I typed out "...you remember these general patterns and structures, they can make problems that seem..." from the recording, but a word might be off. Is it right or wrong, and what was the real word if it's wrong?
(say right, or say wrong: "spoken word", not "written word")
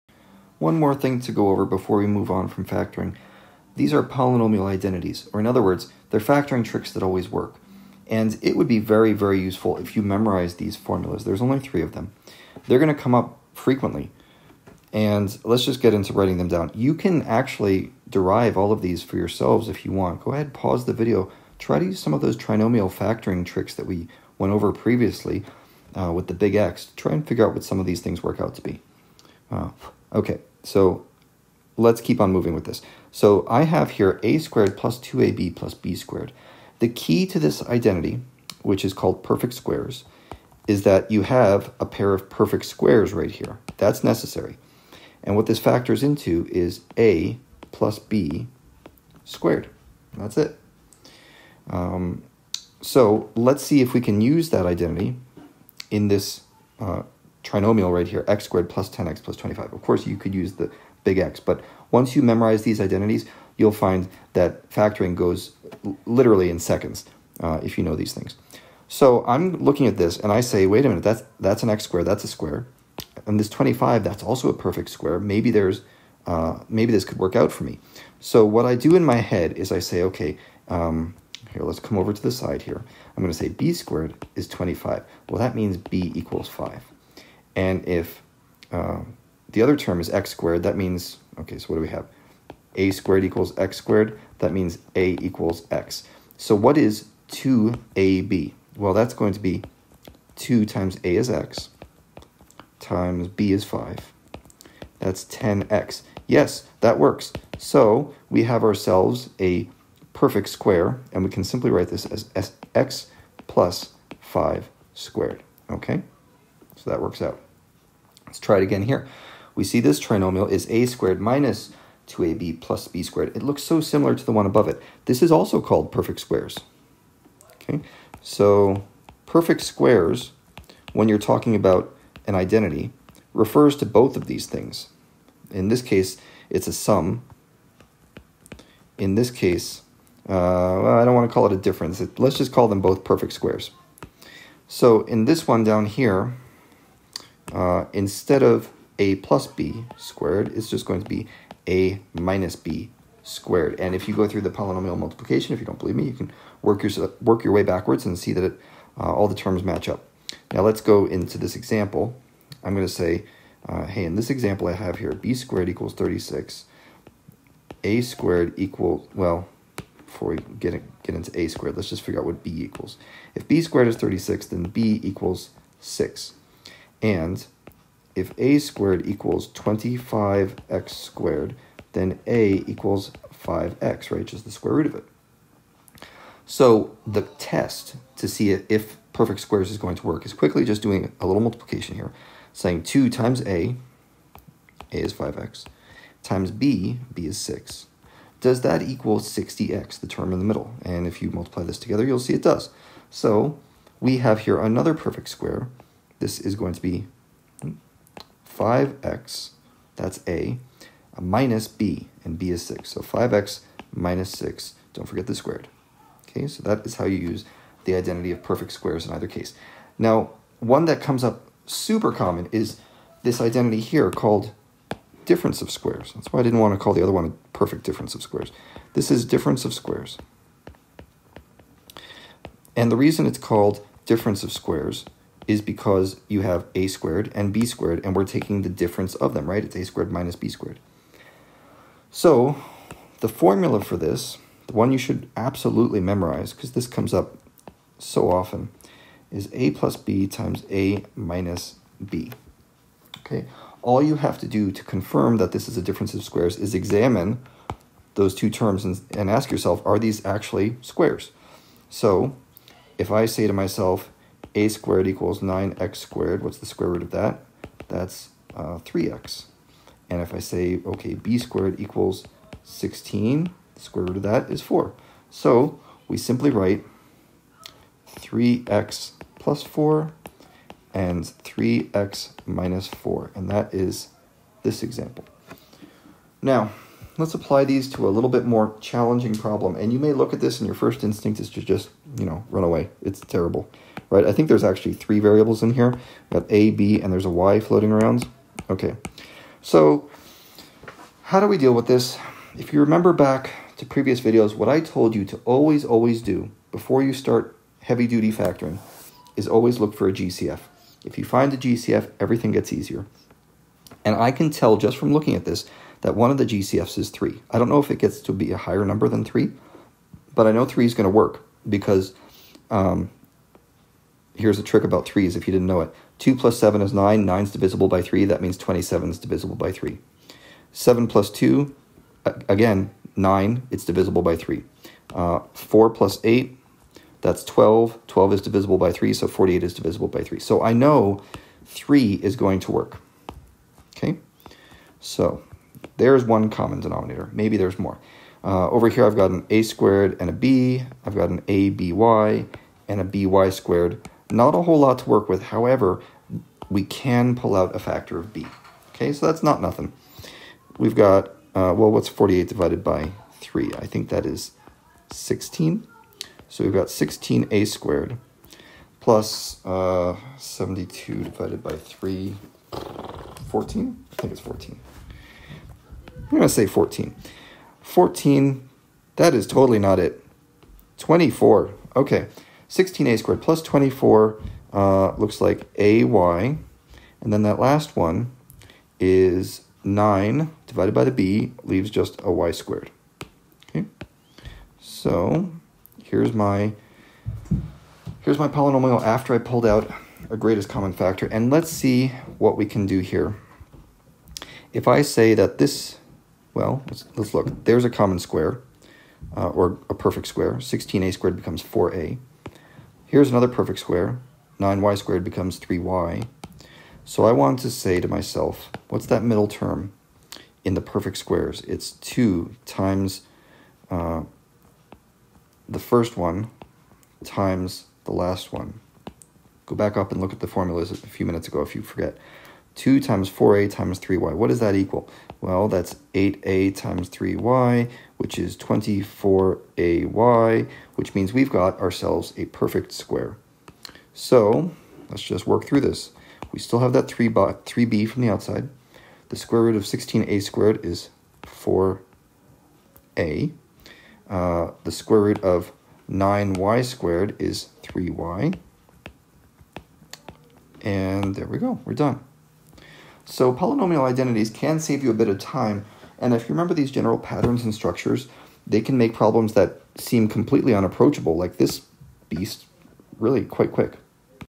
right.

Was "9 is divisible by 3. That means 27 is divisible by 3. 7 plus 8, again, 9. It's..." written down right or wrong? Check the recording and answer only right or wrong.
wrong.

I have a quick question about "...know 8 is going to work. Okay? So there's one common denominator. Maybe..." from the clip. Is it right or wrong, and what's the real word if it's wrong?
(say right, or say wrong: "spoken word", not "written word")
wrong: "3", not "8".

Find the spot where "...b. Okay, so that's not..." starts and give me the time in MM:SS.
05:58.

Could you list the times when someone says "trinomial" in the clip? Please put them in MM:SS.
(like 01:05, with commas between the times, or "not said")
00:22, 00:57, 01:59.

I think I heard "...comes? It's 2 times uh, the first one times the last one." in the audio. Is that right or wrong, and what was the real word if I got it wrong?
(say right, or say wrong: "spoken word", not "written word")
wrong: "squares", not "comes".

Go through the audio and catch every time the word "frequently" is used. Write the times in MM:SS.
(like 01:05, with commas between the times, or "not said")
00:13.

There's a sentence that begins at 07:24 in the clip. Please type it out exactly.
So let's just work through this.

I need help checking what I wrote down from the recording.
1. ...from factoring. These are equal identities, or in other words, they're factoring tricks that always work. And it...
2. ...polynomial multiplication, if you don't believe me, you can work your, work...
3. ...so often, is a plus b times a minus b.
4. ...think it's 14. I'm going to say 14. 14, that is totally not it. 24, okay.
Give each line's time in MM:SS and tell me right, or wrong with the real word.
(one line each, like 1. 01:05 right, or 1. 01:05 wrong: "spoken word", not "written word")
1. 00:02 wrong: "polynomial", not "equal"
2. 02:34 right
3. 04:07 right
4. 06:14 right.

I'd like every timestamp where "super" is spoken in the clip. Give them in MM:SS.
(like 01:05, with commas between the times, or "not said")
03:41.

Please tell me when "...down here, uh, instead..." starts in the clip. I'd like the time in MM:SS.
02:25.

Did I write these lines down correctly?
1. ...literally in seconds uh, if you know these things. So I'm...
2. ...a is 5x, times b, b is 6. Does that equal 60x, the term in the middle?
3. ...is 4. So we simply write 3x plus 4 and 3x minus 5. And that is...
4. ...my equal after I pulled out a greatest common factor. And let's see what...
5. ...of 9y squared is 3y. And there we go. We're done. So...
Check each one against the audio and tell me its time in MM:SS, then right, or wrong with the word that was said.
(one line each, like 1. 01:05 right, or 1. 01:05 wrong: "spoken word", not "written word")
1. 01:06 right
2. 03:14 right
3. 04:34 wrong: "4", not "5"
4. 06:38 wrong: "polynomial", not "equal"
5. 07:35 right.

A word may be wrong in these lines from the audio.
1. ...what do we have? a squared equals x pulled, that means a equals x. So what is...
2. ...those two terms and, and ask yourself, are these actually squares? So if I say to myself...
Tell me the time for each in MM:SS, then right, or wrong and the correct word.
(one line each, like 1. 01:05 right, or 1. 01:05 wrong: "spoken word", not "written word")
1. 01:31 wrong: "squared", not "pulled"
2. 04:18 right.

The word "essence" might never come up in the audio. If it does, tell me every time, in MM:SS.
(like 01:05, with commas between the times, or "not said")
not said.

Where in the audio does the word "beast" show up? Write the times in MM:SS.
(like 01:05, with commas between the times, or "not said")
07:52.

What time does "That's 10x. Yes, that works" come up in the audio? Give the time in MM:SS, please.
01:44.